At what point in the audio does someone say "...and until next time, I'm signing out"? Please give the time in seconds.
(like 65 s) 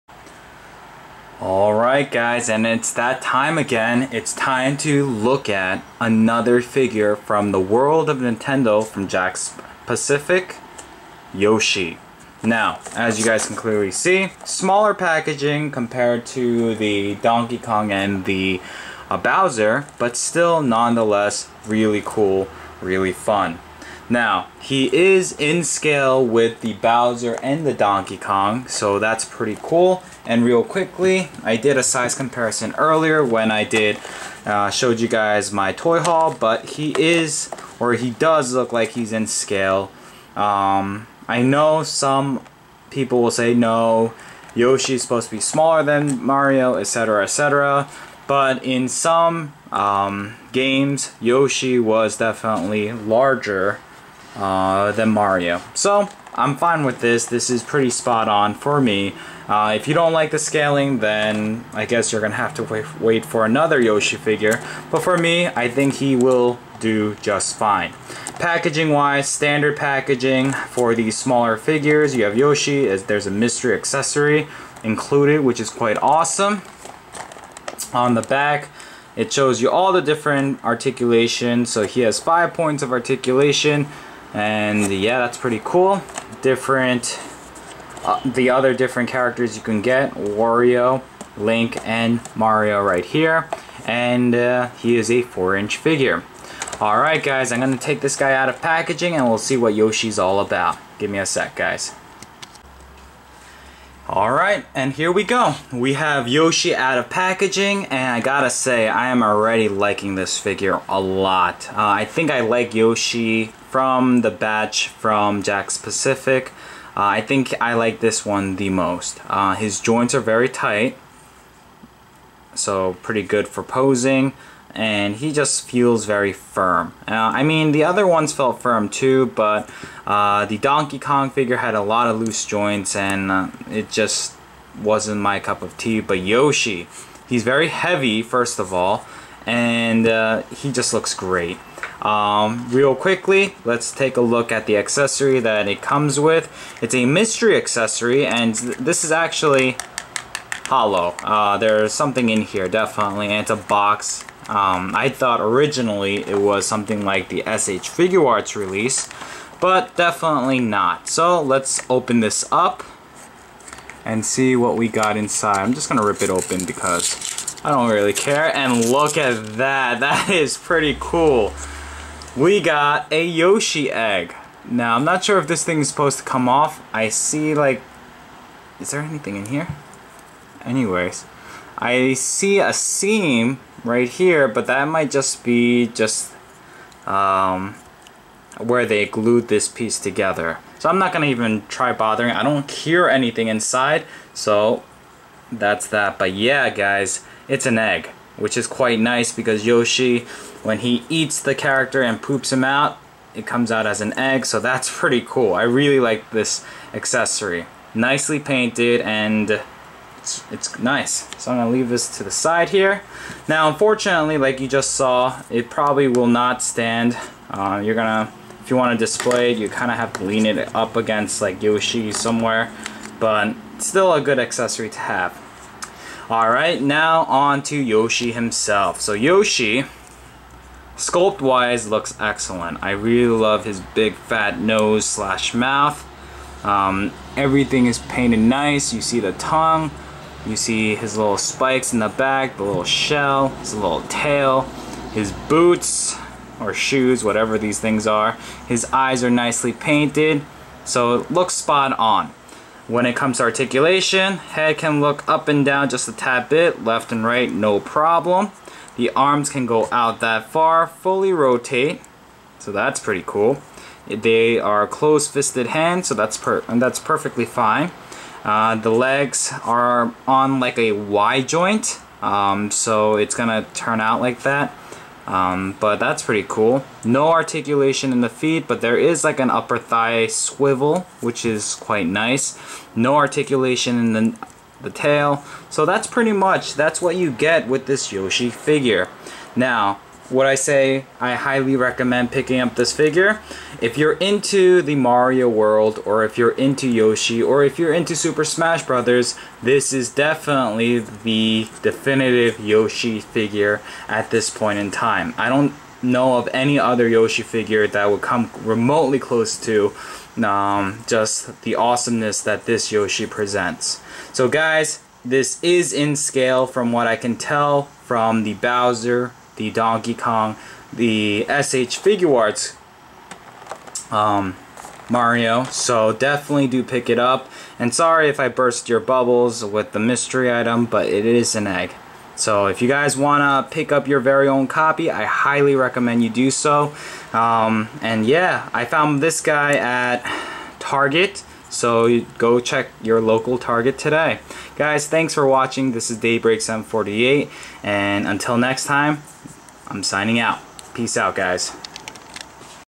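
347 s.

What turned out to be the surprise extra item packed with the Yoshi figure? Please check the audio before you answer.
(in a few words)
Yoshi egg.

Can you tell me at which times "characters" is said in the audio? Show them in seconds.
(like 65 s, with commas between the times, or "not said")
89 s, 201 s.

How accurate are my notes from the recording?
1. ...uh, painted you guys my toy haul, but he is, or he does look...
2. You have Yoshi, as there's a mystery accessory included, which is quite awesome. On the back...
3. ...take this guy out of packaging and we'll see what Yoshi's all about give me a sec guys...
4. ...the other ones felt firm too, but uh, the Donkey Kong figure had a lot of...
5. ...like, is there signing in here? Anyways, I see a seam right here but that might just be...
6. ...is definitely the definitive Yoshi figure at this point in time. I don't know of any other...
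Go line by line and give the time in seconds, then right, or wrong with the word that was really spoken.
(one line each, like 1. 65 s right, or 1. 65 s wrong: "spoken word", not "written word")
1. 34 s wrong: "showed", not "painted"
2. 72 s right
3. 97 s right
4. 127 s right
5. 177 s wrong: "anything", not "signing"
6. 299 s right.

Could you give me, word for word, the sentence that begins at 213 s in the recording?
Now unfortunately, like you just saw, it probably will not stand.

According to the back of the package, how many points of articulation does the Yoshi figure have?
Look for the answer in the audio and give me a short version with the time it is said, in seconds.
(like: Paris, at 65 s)
5, at 82 s.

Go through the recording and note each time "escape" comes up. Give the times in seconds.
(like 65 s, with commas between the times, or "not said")
not said.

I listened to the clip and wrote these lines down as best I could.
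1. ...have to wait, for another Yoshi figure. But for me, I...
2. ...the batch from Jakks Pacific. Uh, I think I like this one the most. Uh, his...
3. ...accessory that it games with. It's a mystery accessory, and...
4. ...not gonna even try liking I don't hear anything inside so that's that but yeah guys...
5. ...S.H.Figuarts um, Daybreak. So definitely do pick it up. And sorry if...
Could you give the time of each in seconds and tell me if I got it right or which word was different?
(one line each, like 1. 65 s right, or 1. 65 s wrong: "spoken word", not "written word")
1. 62 s right
2. 114 s right
3. 144 s wrong: "comes", not "games"
4. 190 s wrong: "bothering", not "liking"
5. 321 s wrong: "Mario", not "Daybreak".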